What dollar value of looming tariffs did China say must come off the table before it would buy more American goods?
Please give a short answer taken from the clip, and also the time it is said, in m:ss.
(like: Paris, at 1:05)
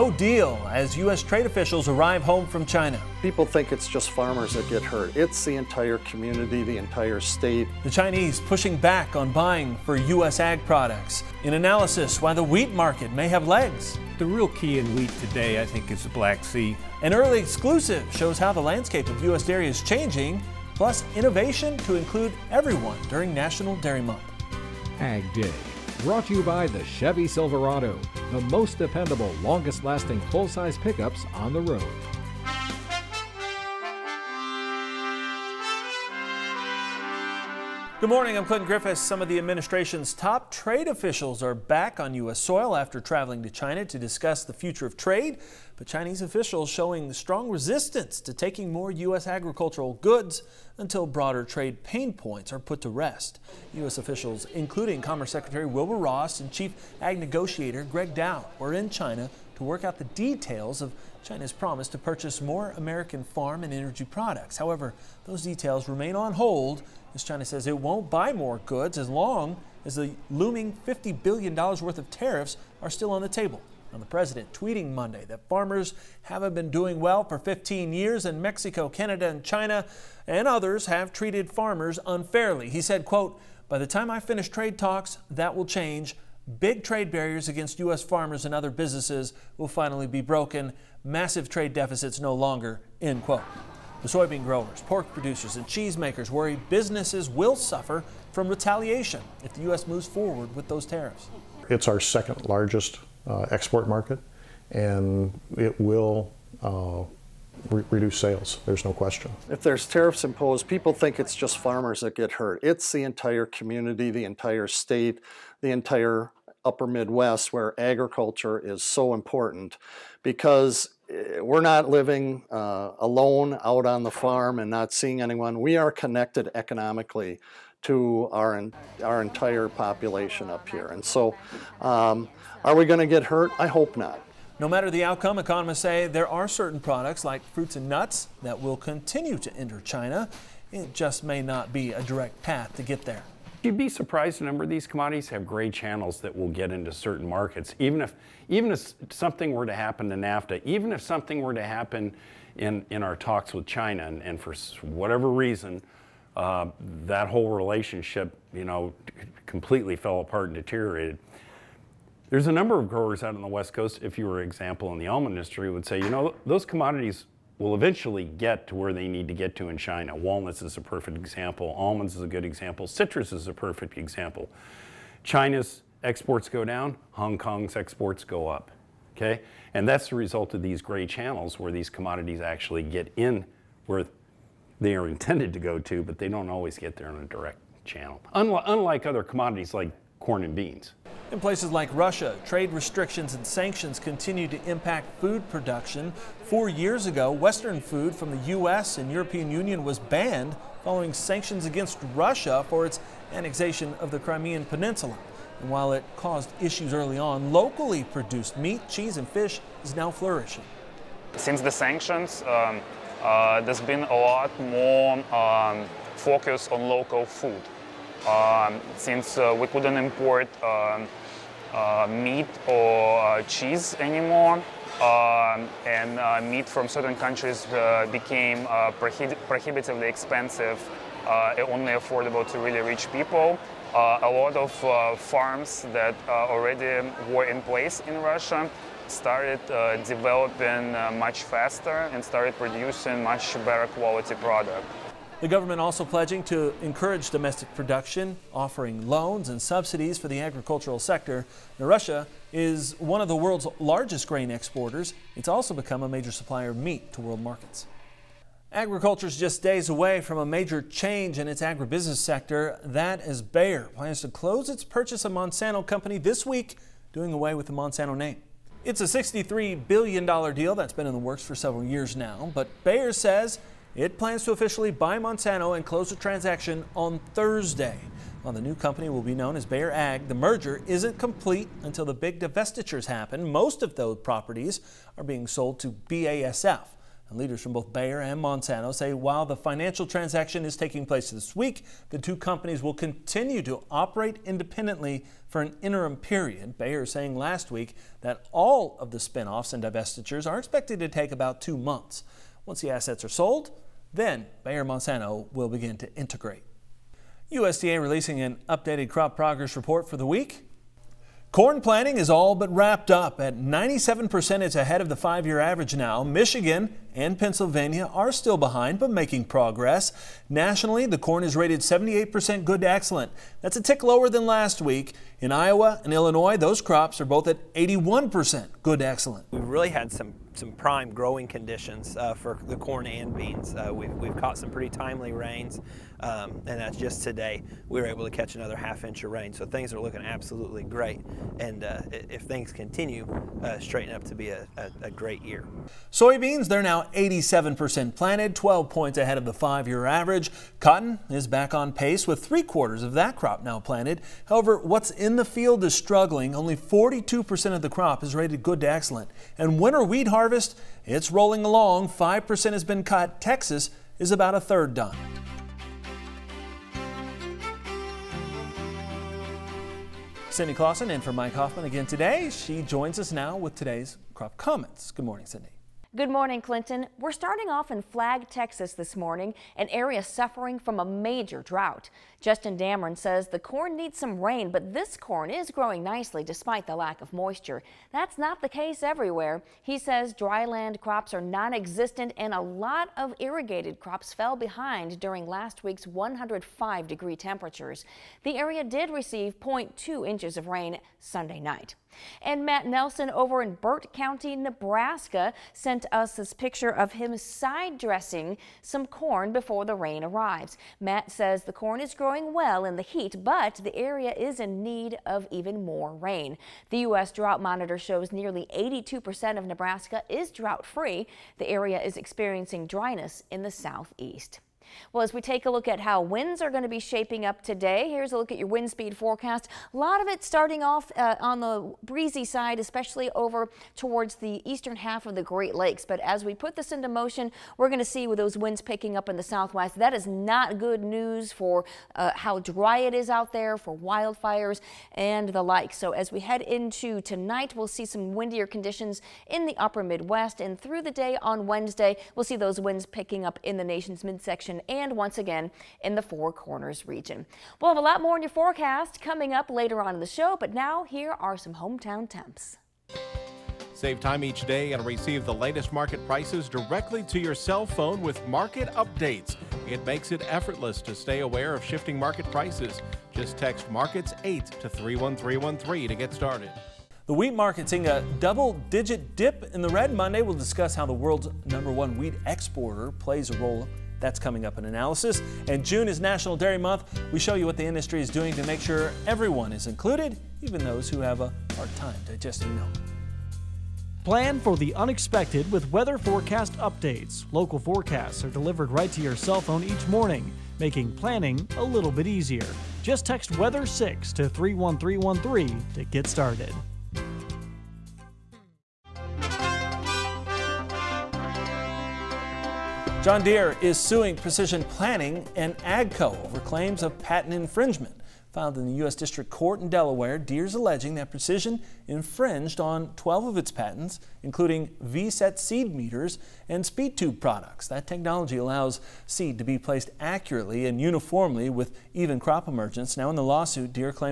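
$50 billion, at 1:10.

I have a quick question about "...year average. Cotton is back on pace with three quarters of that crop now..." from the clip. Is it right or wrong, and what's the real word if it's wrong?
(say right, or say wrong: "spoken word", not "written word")
right.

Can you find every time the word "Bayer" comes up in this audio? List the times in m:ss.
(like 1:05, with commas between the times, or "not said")
4:23, 4:32, 4:39, 4:47, 4:56, 5:04.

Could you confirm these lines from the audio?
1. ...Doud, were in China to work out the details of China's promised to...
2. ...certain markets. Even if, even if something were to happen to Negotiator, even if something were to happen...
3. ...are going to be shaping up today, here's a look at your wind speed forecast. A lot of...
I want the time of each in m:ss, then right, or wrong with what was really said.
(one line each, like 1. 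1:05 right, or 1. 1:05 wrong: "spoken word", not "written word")
1. 0:58 right
2. 2:26 wrong: "NAFTA", not "Negotiator"
3. 7:06 right.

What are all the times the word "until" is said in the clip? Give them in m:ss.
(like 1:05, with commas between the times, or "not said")
0:50, 4:41.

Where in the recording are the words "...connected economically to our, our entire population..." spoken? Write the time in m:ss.
2:05.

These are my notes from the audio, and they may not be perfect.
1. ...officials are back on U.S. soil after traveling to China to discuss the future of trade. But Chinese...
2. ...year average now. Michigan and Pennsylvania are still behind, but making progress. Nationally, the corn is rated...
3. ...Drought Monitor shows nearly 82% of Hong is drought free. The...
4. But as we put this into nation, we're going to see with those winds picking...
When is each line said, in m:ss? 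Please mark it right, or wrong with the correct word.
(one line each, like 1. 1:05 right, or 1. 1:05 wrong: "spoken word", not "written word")
1. 0:40 right
2. 5:15 right
3. 6:57 wrong: "Nebraska", not "Hong"
4. 7:16 wrong: "motion", not "nation".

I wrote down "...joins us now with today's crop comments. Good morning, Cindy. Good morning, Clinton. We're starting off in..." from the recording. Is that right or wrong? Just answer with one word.
right.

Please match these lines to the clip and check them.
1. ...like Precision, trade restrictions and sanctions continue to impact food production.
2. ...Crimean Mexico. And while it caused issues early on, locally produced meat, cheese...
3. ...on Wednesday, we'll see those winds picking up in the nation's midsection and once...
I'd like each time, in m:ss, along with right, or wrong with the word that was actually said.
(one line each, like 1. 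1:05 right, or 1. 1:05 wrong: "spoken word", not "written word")
1. 3:11 wrong: "Russia", not "Precision"
2. 3:24 wrong: "Peninsula", not "Mexico"
3. 7:31 right.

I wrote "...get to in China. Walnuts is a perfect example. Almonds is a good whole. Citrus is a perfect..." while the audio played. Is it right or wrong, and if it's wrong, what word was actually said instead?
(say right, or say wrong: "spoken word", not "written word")
wrong: "example", not "whole".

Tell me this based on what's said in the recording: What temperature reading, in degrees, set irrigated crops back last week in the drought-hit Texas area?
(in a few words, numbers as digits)
105 degrees.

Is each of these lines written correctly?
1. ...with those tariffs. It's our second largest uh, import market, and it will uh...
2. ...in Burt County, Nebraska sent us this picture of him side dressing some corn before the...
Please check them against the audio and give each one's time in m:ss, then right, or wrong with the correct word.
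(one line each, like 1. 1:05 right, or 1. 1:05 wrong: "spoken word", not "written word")
1. 1:40 wrong: "export", not "import"
2. 6:43 right.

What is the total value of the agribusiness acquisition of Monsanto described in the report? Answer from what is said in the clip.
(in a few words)
$63 billion.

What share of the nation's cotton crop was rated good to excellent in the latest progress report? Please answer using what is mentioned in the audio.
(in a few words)
42%.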